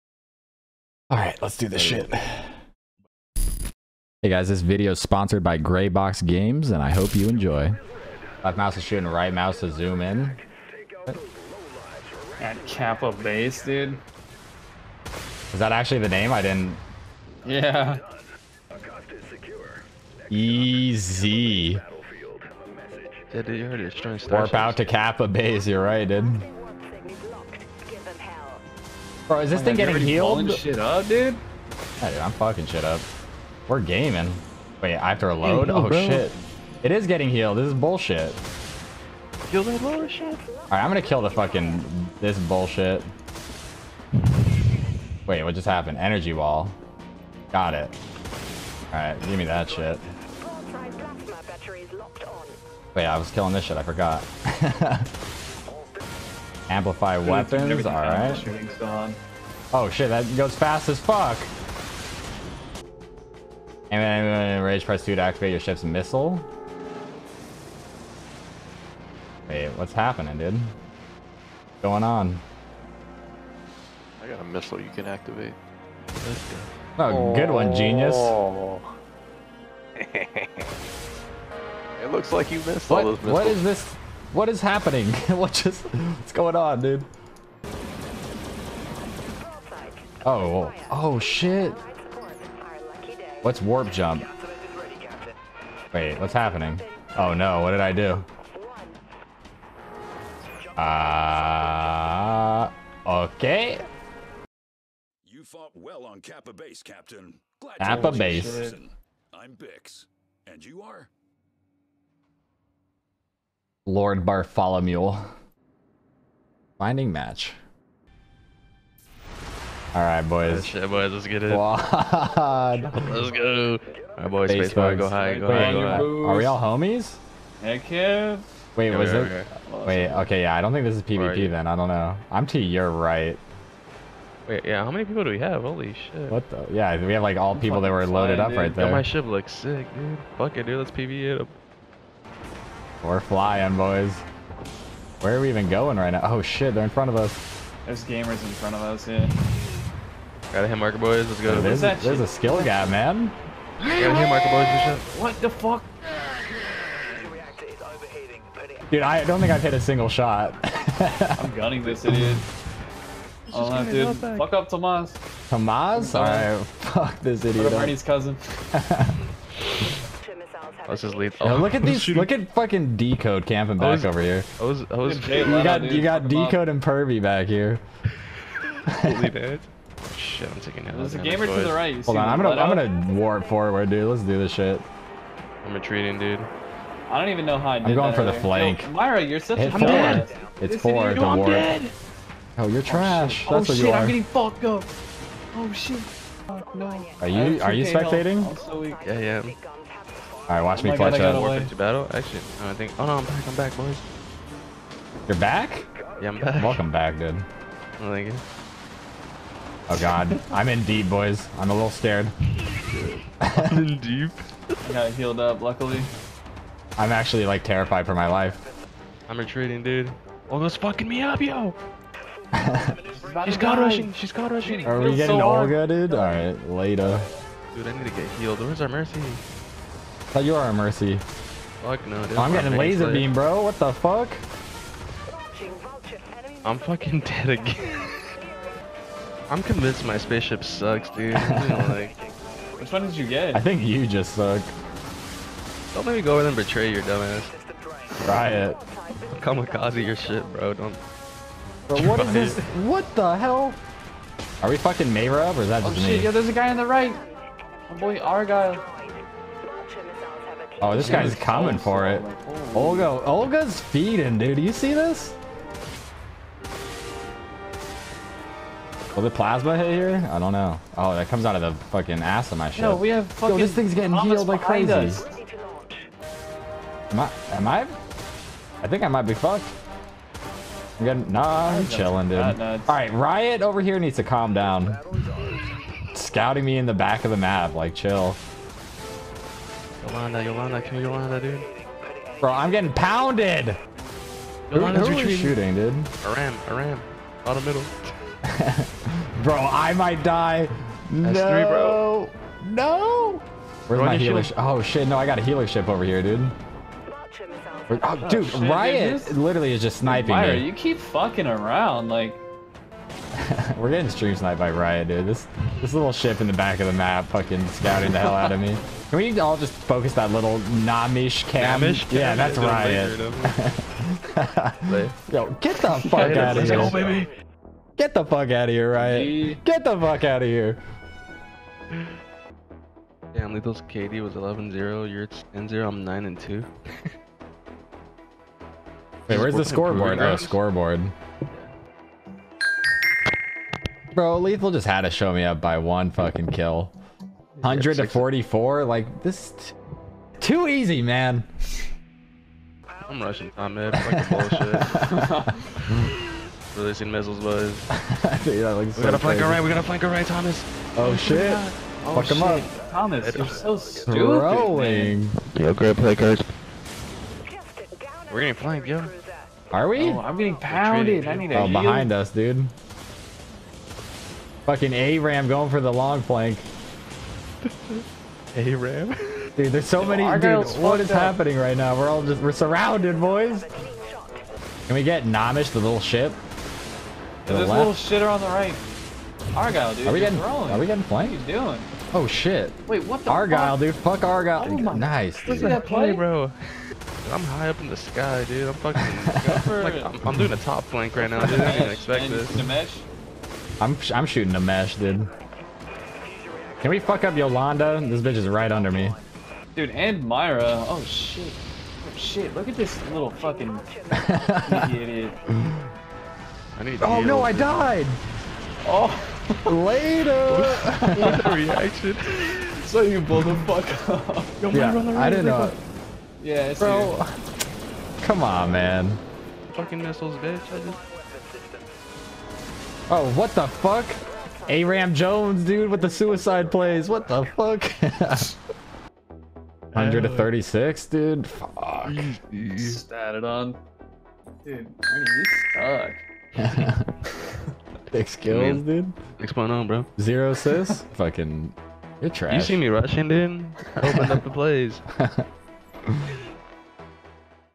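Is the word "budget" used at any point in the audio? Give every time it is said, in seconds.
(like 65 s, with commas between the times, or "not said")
not said.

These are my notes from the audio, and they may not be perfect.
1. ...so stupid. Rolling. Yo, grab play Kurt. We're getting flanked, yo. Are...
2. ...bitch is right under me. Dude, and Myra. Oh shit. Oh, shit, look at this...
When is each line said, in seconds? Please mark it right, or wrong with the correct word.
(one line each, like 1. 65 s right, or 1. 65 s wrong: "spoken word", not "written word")
1. 363 s right
2. 408 s right.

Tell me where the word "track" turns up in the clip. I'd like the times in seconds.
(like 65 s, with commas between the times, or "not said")
not said.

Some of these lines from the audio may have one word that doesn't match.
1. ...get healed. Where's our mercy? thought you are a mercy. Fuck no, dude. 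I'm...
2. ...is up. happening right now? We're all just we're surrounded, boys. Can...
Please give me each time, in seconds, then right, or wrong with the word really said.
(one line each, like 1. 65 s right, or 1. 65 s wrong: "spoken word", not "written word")
1. 228 s right
2. 381 s right.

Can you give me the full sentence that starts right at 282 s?
All right, Riot over here needs to calm down.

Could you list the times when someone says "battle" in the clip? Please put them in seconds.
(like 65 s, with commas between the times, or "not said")
201 s.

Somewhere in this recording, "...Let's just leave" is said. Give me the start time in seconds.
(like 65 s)
170 s.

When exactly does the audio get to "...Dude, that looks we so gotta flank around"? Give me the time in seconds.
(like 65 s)
358 s.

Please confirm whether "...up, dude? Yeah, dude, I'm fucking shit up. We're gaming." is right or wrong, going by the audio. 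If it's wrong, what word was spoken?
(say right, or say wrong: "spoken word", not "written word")
right.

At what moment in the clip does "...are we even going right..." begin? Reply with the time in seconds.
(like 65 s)
145 s.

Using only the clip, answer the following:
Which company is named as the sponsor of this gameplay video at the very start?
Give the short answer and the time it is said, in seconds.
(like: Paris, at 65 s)
Greybox Games, at 5 s.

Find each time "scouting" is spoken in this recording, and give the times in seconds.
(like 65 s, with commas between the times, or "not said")
286 s, 317 s.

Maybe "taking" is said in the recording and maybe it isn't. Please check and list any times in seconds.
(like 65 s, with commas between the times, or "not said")
180 s.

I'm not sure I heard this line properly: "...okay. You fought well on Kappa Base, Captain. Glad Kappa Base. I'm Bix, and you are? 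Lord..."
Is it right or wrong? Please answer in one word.
right.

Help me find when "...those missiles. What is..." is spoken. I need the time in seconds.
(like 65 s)
83 s.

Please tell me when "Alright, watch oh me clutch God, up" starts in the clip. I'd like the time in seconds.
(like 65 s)
200 s.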